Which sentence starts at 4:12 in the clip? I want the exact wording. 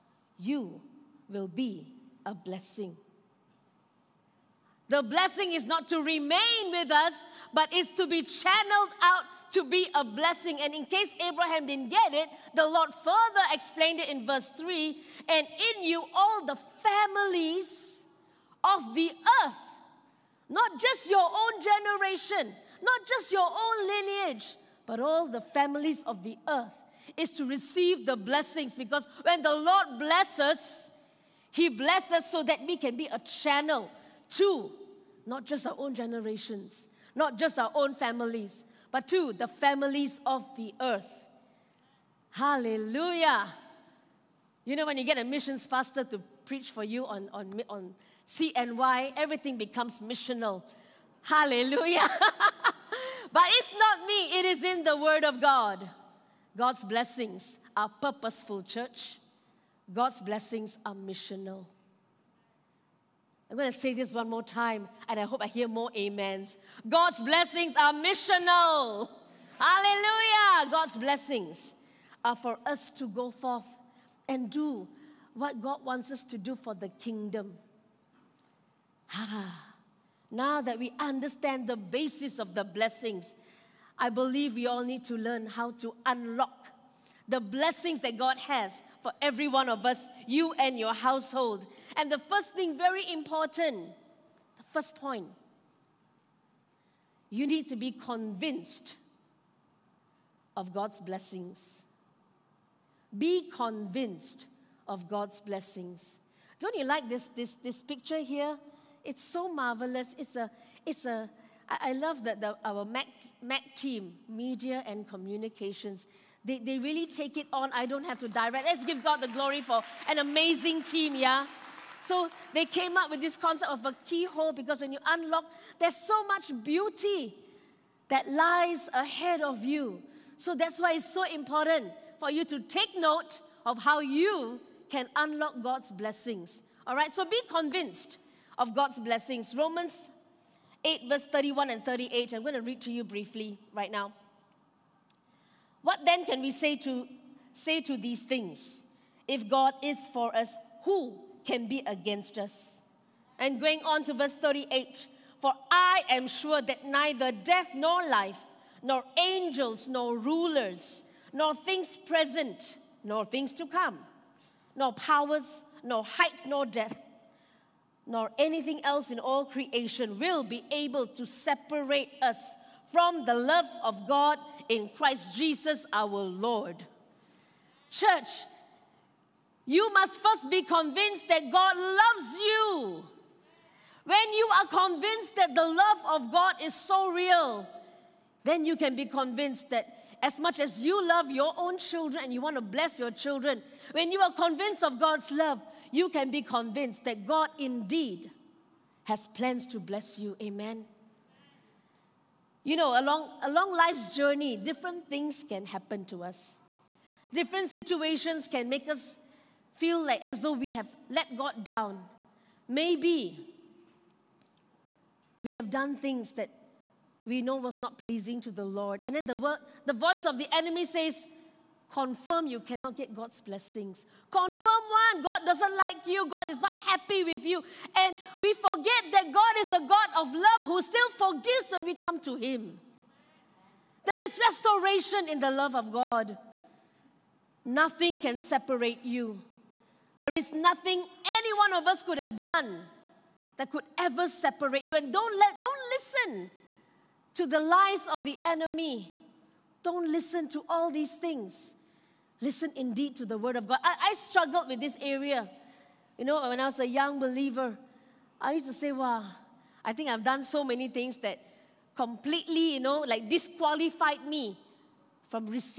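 Listen indeed to the word of God.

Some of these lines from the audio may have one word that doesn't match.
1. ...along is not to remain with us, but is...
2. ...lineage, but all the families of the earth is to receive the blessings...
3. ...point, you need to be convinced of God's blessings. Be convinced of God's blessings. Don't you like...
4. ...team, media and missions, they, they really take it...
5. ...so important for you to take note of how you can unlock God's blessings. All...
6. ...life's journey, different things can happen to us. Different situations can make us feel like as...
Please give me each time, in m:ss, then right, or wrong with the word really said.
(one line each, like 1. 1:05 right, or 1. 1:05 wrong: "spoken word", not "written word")
1. 0:05 wrong: "blessing", not "along"
2. 0:23 right
3. 1:34 right
4. 1:53 wrong: "communications", not "missions"
5. 2:11 right
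6. 3:23 right.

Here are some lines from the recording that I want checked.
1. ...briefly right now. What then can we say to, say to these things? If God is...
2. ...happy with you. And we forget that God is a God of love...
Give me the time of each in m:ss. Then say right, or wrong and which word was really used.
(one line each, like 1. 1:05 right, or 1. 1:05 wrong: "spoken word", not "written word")
1. 2:23 right
2. 3:46 right.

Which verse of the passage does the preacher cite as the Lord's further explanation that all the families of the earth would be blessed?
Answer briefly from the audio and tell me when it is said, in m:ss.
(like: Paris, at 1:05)
verse 3, at 0:14.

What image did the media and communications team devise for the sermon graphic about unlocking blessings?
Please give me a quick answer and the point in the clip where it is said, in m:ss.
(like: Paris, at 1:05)
keyhole, at 2:04.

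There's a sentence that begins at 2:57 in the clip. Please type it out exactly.
Church, you must first be convinced that God loves you.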